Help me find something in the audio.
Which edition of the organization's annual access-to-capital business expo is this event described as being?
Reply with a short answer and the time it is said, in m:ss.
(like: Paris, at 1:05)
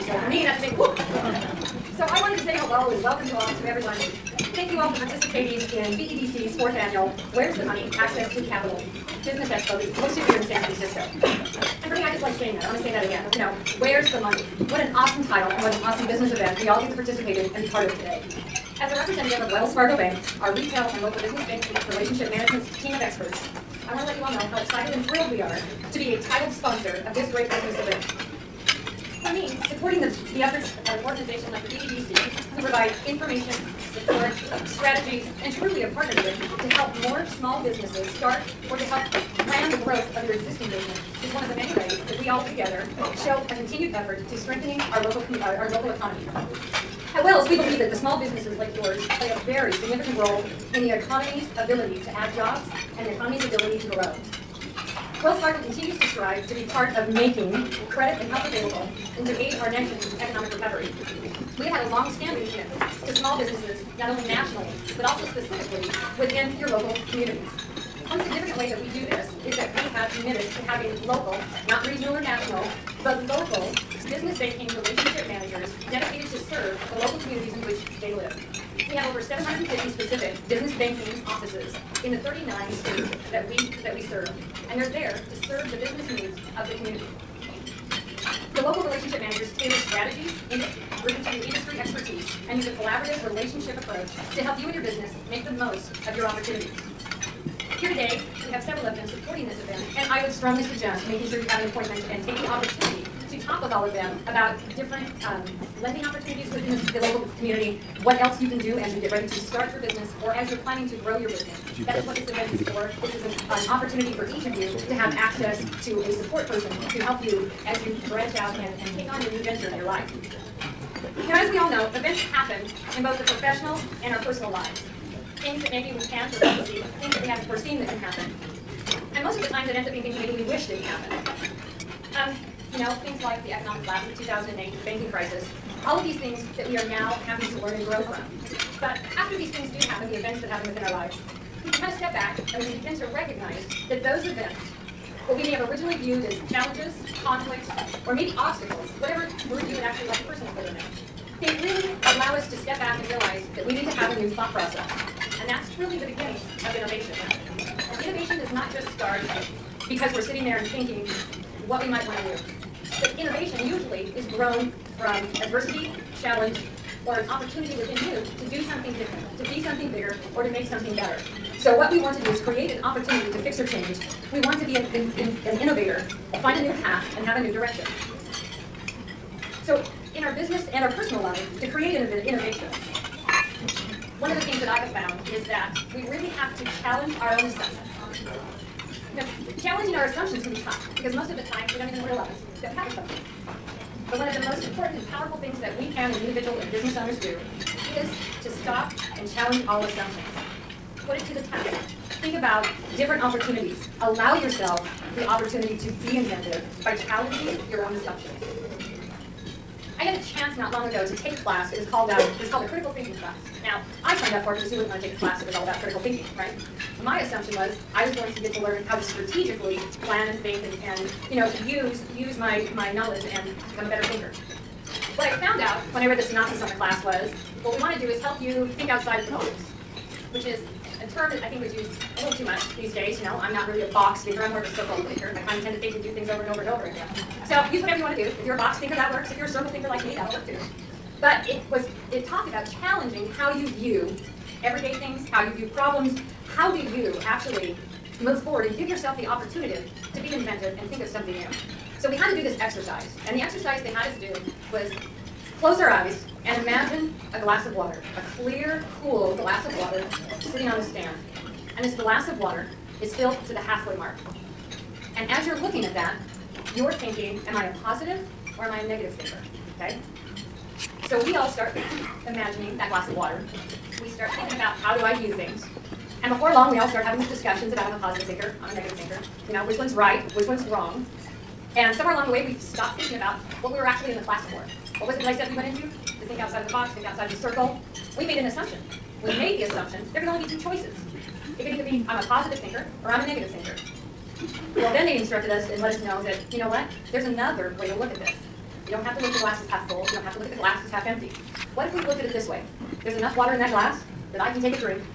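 fourth, at 0:06.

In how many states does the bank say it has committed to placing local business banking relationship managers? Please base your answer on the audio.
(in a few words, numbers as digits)
39.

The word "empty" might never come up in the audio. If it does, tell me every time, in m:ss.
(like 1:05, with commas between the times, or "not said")
5:01.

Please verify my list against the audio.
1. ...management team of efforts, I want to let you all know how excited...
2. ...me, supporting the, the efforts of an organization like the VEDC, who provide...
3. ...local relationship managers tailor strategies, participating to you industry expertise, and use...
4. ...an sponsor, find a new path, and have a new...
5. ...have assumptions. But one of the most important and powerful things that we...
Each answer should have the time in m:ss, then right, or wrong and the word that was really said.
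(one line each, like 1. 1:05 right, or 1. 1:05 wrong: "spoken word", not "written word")
1. 0:22 wrong: "experts", not "efforts"
2. 0:29 right
3. 1:28 wrong: "bring", not "participating"
4. 2:55 wrong: "innovator", not "sponsor"
5. 3:12 right.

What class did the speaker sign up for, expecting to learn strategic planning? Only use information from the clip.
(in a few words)
critical thinking class.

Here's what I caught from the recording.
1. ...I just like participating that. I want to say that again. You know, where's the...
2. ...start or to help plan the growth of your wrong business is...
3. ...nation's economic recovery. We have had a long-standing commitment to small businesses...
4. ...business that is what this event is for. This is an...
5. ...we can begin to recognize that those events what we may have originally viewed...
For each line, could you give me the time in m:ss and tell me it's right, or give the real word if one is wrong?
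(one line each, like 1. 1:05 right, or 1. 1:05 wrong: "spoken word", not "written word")
1. 0:12 wrong: "saying", not "participating"
2. 0:38 wrong: "existing", not "wrong"
3. 0:59 right
4. 1:51 right
5. 2:22 right.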